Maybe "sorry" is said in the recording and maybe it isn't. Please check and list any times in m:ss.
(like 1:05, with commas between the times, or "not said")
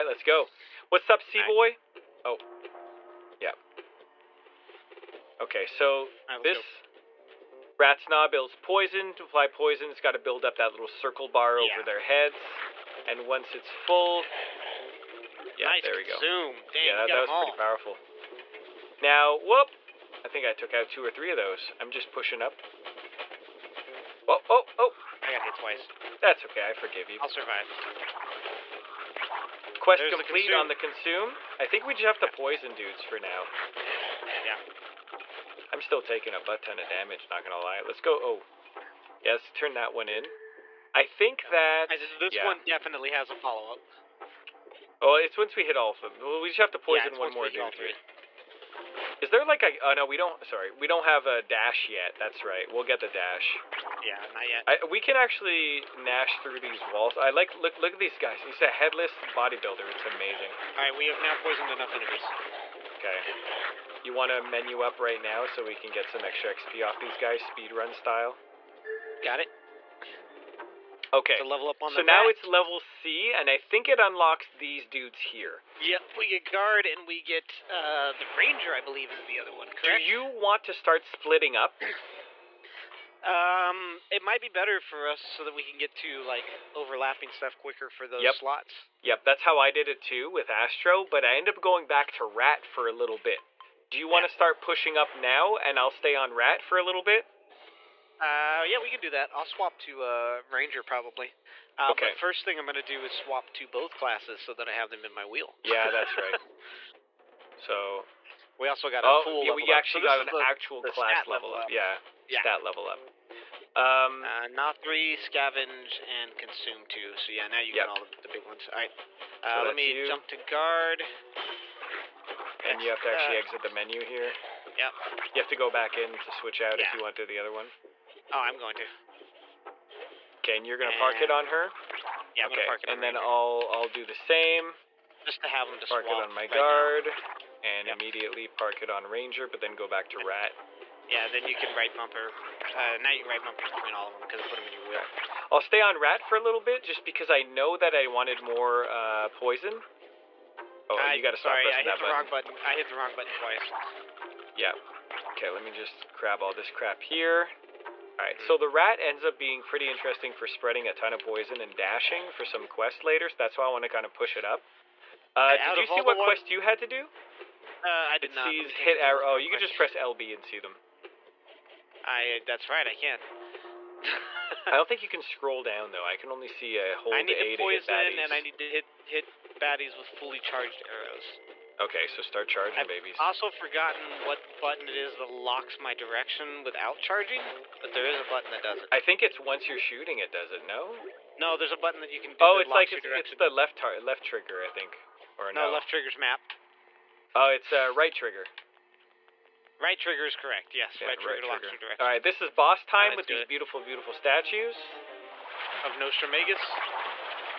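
0:50, 2:31.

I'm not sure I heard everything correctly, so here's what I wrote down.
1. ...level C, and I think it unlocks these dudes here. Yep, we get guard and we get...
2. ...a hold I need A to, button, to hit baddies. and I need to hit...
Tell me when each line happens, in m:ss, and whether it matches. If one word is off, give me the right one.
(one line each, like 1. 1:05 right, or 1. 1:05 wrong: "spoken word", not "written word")
1. 1:12 right
2. 2:56 wrong: "poison", not "button".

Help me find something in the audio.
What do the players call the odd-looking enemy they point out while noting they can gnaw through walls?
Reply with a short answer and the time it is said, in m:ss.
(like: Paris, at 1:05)
Headless bodybuilder, at 0:58.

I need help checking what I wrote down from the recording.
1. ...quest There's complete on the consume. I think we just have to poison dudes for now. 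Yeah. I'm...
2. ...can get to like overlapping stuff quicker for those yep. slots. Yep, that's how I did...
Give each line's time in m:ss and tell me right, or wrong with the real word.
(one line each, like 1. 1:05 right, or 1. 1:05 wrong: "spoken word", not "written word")
1. 0:29 right
2. 1:25 right.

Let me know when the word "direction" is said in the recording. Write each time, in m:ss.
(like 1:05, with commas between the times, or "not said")
3:05, 3:21.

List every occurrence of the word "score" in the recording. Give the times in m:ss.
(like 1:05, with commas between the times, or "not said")
not said.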